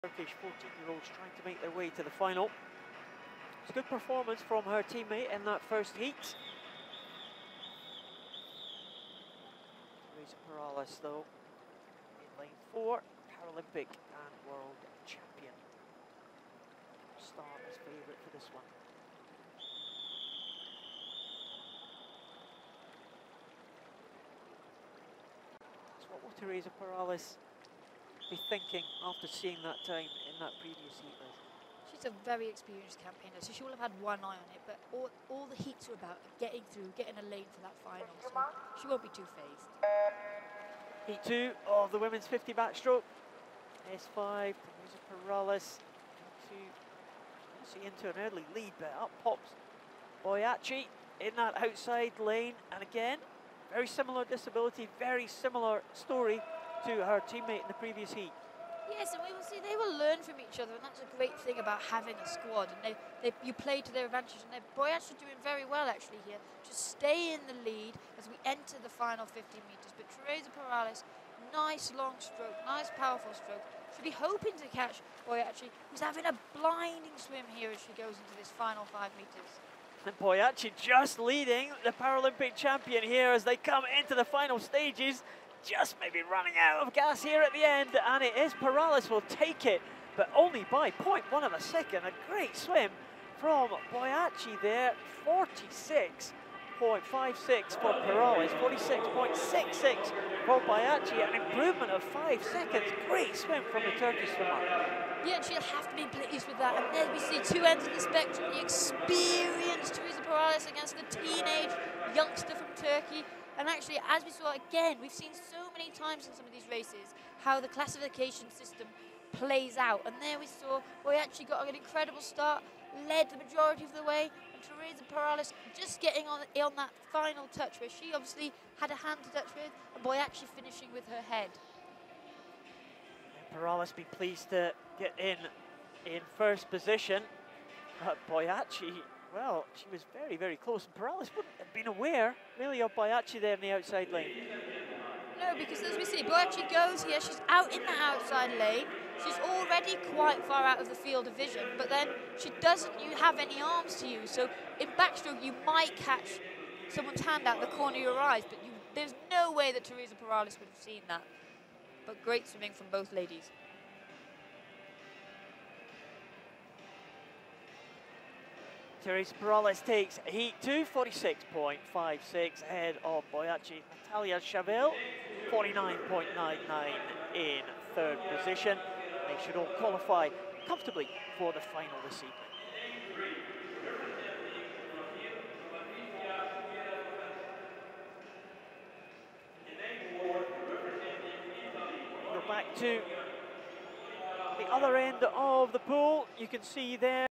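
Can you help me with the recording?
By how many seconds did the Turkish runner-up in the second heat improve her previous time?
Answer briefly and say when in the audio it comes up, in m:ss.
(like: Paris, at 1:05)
5 seconds, at 1:42.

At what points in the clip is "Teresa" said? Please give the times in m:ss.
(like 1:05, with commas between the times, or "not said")
0:10, 0:26, 1:10, 1:49, 2:04, 2:39.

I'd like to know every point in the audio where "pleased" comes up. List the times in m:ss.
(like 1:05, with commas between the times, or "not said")
1:46, 2:14.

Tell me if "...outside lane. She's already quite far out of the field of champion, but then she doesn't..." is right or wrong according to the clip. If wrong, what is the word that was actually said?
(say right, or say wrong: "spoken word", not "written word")
wrong: "vision", not "champion".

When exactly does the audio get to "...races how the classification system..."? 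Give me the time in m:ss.
1:56.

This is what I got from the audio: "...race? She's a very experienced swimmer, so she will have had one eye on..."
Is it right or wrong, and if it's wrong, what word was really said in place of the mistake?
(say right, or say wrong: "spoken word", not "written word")
wrong: "campaigner", not "swimmer".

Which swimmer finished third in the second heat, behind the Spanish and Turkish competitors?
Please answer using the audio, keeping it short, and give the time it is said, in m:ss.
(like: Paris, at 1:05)
Natalia Shavel, at 2:54.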